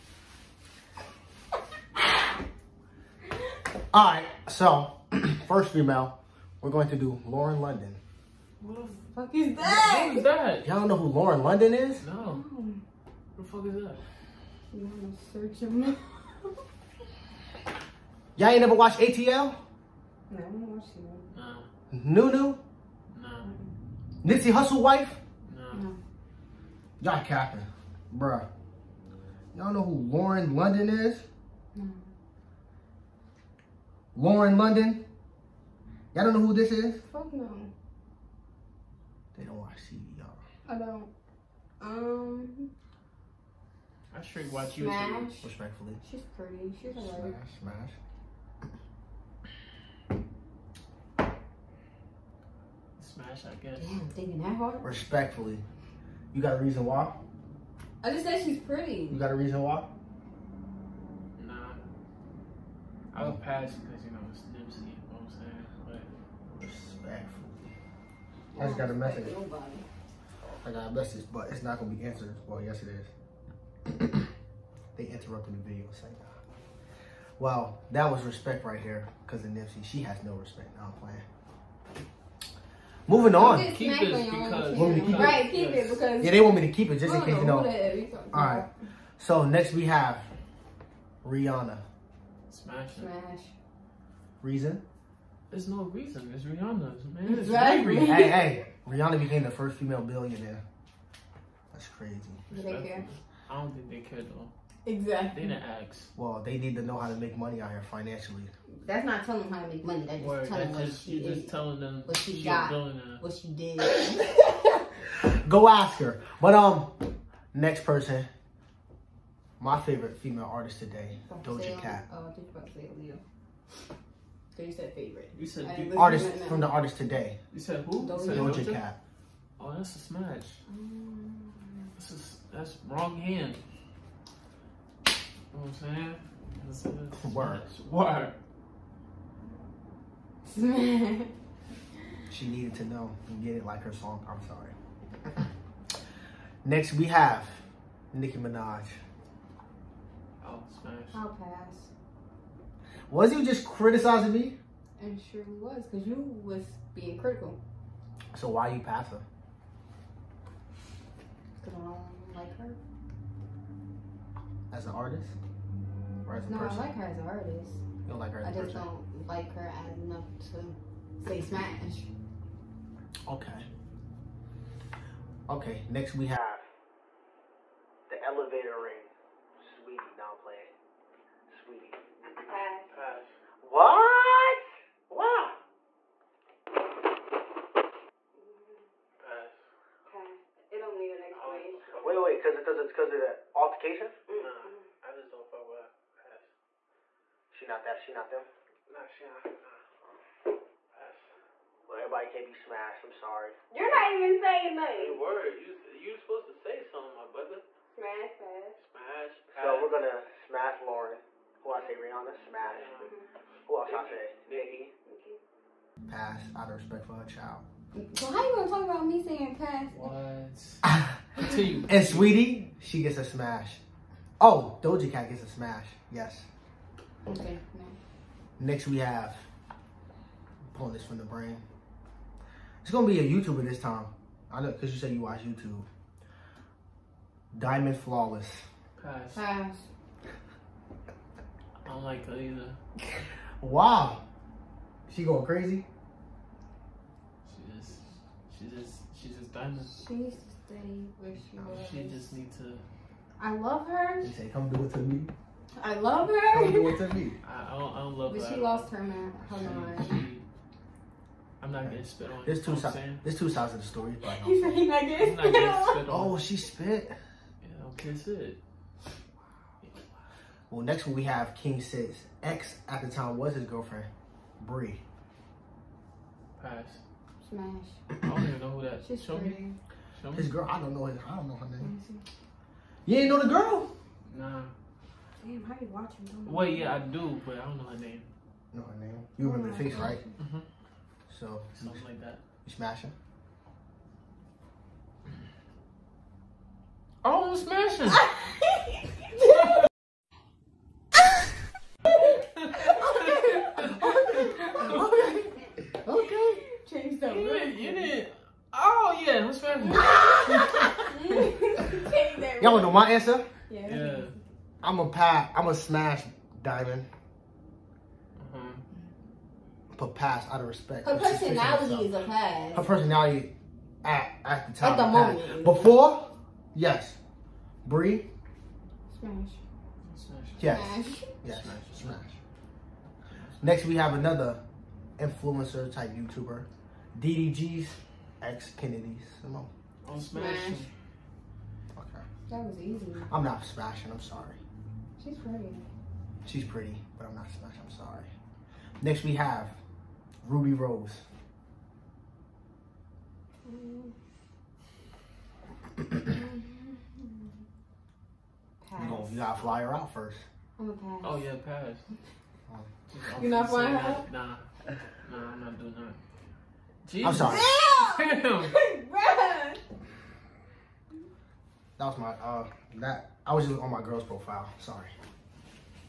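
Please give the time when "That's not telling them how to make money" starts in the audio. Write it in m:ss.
1:48.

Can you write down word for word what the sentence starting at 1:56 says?
But um, next person, my favorite female artist today, Doja Cat.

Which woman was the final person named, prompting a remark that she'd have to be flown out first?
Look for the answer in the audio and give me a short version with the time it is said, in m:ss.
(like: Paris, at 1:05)
Rubi Rose, at 5:50.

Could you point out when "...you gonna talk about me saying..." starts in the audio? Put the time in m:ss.
3:38.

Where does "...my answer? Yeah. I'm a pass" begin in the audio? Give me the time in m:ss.
5:12.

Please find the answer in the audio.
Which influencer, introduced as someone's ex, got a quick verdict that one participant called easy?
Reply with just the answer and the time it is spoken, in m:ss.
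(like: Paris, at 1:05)
Kennedy Simone, at 5:38.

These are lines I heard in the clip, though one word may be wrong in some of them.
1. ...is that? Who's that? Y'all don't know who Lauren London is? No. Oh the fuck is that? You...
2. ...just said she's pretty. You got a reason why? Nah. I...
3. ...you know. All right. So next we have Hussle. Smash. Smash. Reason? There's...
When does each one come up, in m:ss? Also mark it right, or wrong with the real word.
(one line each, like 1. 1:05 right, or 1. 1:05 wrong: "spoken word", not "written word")
1. 0:09 right
2. 0:58 right
3. 1:27 wrong: "Rihanna", not "Hussle".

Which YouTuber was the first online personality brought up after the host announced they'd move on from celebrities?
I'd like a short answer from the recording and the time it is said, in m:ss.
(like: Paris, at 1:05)
Diamond Flawless, at 3:57.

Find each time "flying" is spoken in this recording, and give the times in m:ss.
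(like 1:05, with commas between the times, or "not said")
6:03.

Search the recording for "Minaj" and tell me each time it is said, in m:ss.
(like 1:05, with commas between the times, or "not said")
2:28.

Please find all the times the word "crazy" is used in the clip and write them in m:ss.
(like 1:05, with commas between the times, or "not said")
1:41, 4:05.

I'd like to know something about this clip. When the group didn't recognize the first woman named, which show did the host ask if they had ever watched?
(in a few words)
ATL.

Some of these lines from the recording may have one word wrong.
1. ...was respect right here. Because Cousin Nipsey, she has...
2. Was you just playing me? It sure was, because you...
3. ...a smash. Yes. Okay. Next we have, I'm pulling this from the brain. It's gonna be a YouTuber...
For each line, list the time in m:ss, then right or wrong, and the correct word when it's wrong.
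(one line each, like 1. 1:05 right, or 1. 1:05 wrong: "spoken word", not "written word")
1. 1:18 right
2. 2:33 wrong: "criticizing", not "playing"
3. 3:45 right.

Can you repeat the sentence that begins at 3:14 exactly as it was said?
Nah, I just don't fuck with Pass.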